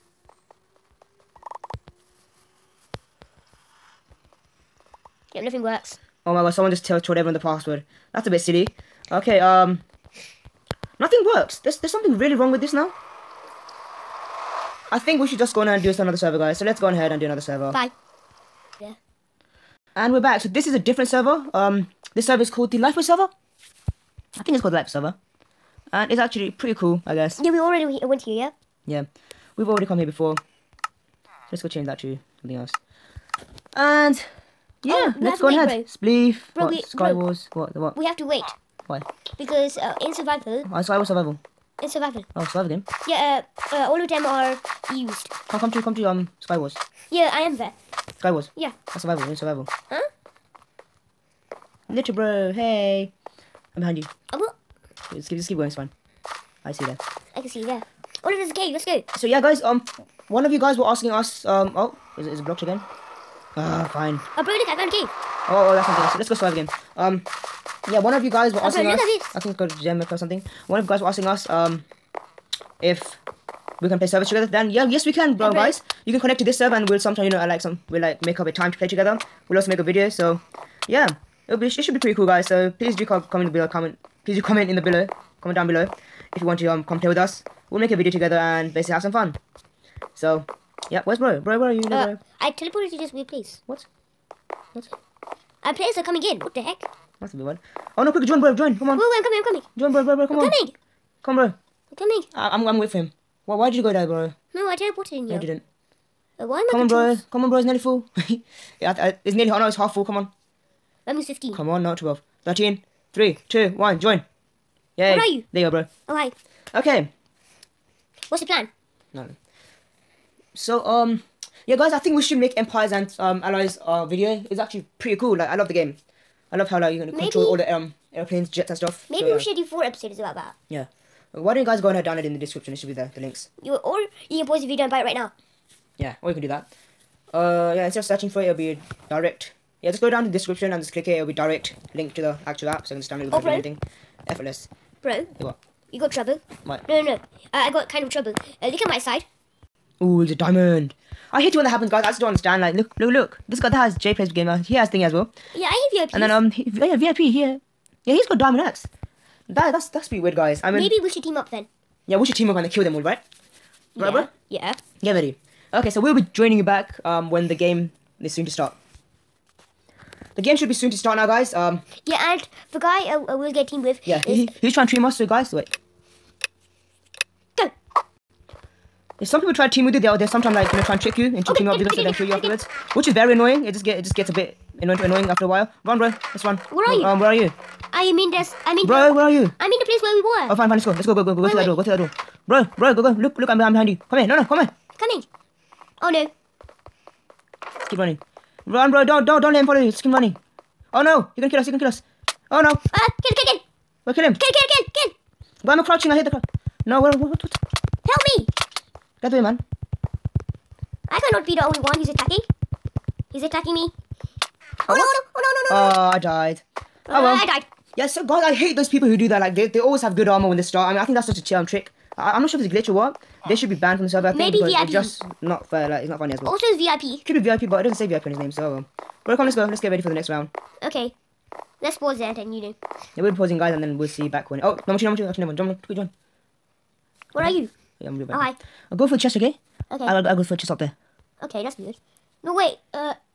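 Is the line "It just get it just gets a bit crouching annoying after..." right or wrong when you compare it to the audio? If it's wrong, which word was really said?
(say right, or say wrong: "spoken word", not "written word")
wrong: "annoying", not "crouching".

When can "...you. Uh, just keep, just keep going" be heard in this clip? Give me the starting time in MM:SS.
00:53.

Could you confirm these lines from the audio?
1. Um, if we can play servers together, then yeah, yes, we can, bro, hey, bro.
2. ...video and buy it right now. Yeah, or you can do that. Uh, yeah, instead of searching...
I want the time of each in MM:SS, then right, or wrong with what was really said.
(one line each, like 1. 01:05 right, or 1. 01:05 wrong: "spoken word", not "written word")
1. 01:11 right
2. 02:14 right.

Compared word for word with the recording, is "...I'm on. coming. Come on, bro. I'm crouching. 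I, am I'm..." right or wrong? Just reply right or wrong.
wrong.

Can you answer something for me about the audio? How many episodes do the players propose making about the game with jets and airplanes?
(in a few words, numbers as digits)
4.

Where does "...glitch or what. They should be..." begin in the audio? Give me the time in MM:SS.
03:42.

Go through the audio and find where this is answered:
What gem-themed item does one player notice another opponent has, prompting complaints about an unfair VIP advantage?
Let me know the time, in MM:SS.
02:38.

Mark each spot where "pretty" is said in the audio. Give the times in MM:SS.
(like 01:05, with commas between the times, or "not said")
00:26, 01:21, 02:04, 02:40.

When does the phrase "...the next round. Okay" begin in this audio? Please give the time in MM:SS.
03:50.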